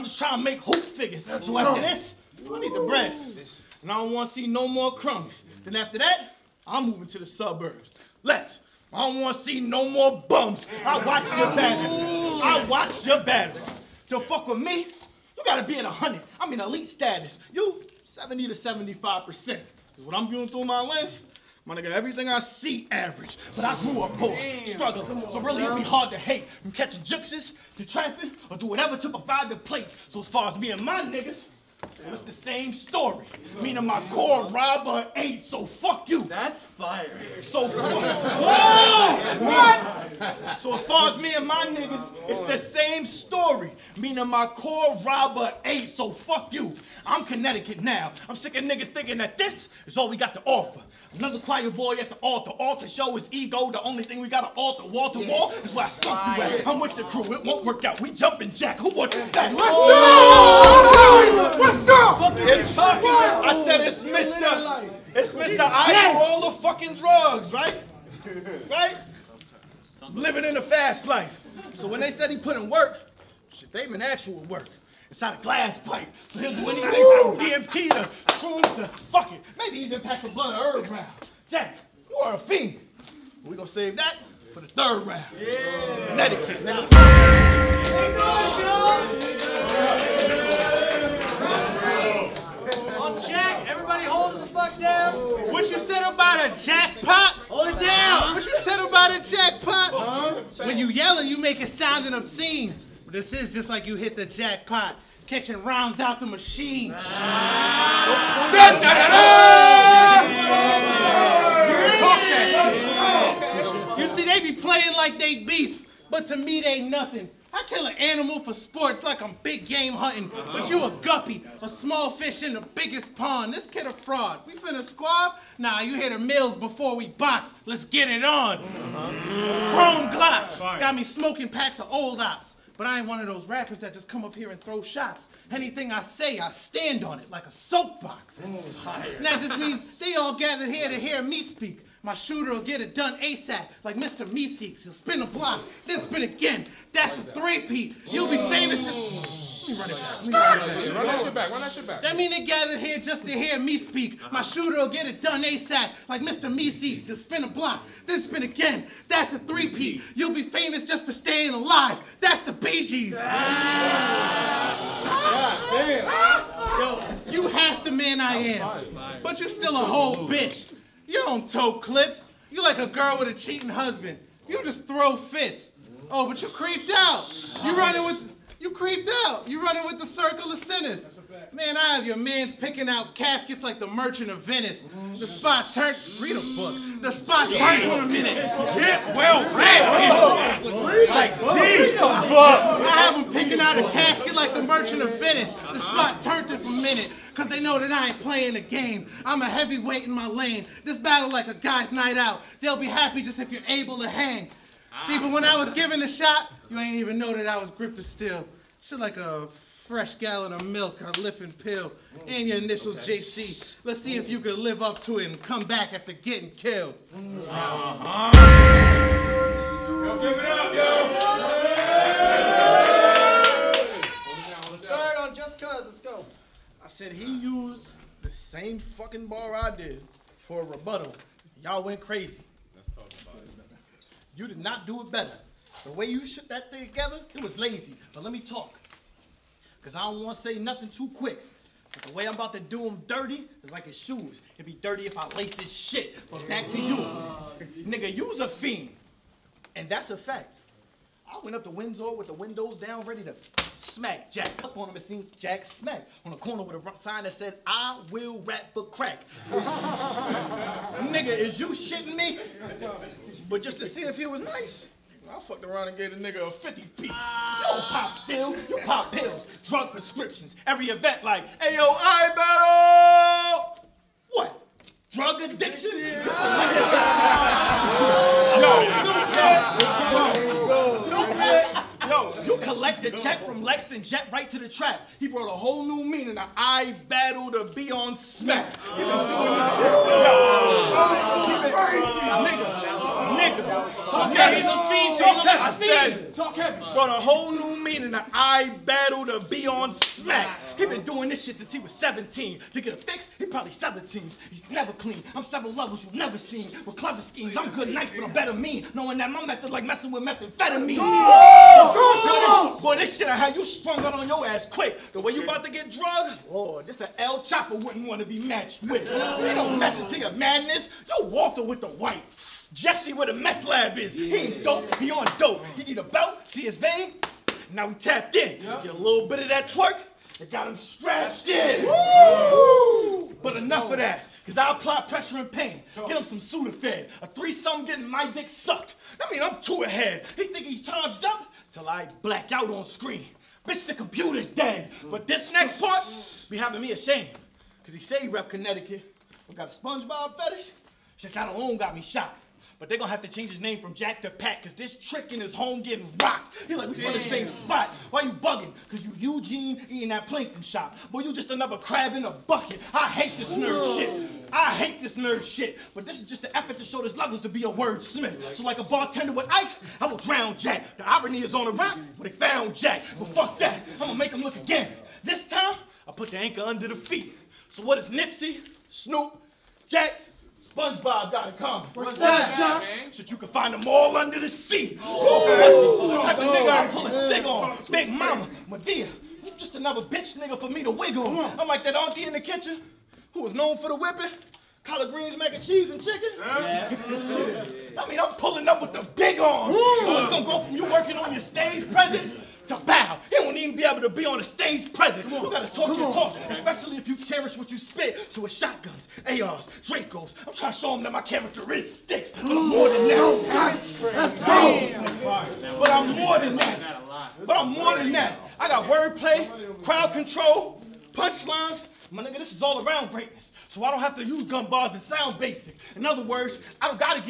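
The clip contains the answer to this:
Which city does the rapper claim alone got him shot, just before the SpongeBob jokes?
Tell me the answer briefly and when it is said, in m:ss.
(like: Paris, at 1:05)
Chicago, at 5:51.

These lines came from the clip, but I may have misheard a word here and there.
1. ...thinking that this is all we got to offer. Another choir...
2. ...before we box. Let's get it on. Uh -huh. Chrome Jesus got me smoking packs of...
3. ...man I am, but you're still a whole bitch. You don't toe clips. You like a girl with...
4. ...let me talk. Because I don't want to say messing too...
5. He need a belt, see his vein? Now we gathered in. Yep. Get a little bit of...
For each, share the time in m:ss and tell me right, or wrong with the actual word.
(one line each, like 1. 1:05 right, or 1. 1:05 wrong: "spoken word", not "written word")
1. 0:48 right
2. 2:06 wrong: "Glock", not "Jesus"
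3. 2:47 right
4. 3:58 wrong: "nothing", not "messing"
5. 5:25 wrong: "tapped", not "gathered".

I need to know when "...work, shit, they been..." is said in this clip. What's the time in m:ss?
1:12.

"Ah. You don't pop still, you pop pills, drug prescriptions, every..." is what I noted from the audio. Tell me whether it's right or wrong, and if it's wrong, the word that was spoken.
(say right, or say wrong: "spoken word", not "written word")
right.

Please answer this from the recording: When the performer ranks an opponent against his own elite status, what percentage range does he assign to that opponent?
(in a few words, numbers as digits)
70 to 75 percent.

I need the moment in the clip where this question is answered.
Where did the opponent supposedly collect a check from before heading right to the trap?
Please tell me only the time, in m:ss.
4:43.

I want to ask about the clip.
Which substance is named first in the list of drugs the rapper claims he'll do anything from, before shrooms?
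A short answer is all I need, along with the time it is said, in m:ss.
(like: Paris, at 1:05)
DMT, at 1:17.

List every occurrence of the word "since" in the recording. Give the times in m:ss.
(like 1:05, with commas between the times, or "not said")
5:01.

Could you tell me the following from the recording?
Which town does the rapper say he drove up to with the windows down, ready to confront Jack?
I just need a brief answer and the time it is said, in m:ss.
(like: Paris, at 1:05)
Windsor, at 4:11.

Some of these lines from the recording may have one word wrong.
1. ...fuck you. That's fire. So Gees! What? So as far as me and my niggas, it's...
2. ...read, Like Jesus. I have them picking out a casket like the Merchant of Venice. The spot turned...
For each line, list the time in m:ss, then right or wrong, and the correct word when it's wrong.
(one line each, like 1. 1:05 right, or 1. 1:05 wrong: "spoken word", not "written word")
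1. 0:35 wrong: "Whoa", not "Gees"
2. 3:09 right.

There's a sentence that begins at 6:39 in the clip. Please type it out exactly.
So it's gonna go from you working on your stage presence to back even be able to be on the stage present.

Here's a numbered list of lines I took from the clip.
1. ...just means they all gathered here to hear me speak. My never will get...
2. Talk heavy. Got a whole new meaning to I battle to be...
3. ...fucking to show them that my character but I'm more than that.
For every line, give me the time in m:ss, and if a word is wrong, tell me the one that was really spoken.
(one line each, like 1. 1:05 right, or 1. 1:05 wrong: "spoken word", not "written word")
1. 2:19 wrong: "shooter", not "never"
2. 4:56 right
3. 6:50 wrong: "trying", not "fucking".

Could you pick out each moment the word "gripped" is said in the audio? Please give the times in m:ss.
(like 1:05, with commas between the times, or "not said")
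3:27.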